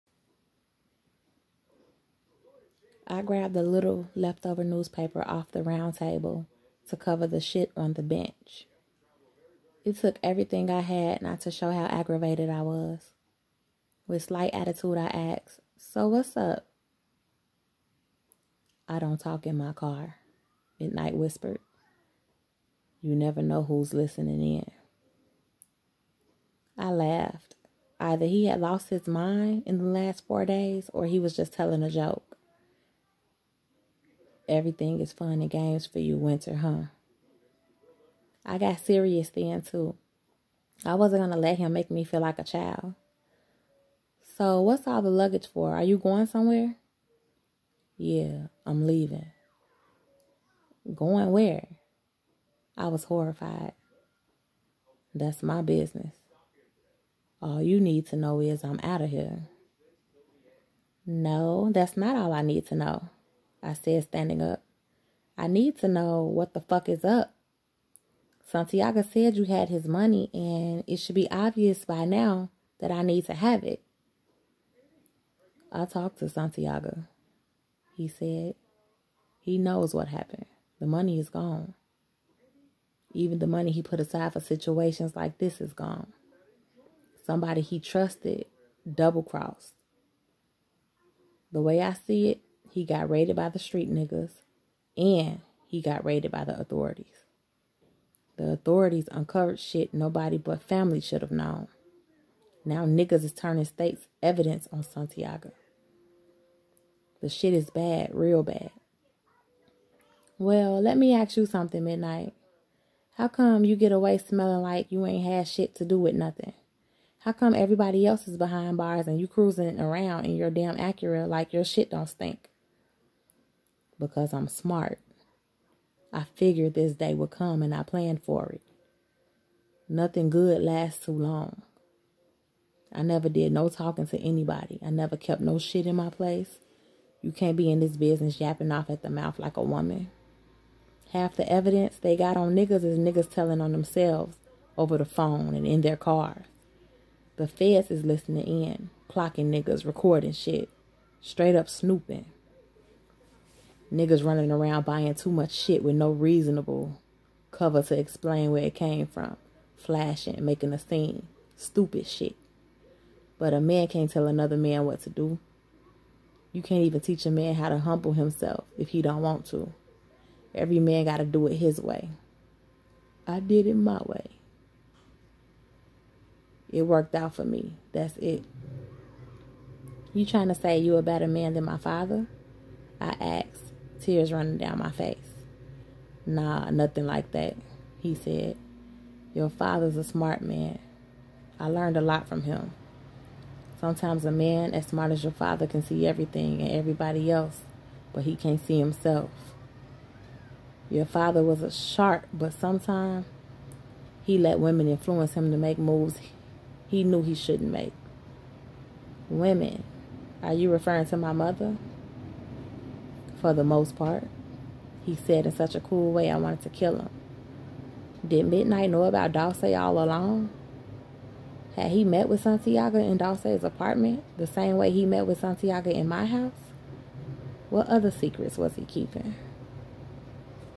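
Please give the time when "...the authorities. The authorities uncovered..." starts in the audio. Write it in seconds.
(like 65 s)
96 s.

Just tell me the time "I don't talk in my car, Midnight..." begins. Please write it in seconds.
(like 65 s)
18 s.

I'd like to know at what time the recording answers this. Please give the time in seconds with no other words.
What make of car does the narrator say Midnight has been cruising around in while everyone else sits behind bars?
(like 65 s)
120 s.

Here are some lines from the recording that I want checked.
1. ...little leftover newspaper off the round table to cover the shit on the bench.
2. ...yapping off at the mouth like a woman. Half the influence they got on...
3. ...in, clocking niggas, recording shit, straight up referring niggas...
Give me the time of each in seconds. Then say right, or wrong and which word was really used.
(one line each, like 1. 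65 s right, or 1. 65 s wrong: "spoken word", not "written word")
1. 3 s right
2. 138 s wrong: "evidence", not "influence"
3. 148 s wrong: "snooping", not "referring".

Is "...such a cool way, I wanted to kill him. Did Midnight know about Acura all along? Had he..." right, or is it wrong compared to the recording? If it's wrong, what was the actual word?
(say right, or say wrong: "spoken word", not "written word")
wrong: "Dawsey", not "Acura".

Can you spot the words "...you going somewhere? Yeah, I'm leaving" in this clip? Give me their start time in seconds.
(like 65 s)
45 s.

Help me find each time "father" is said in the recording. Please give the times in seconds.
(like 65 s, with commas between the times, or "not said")
181 s, 189 s, 195 s, 201 s.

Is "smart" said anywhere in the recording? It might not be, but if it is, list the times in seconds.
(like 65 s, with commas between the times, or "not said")
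124 s, 190 s, 194 s.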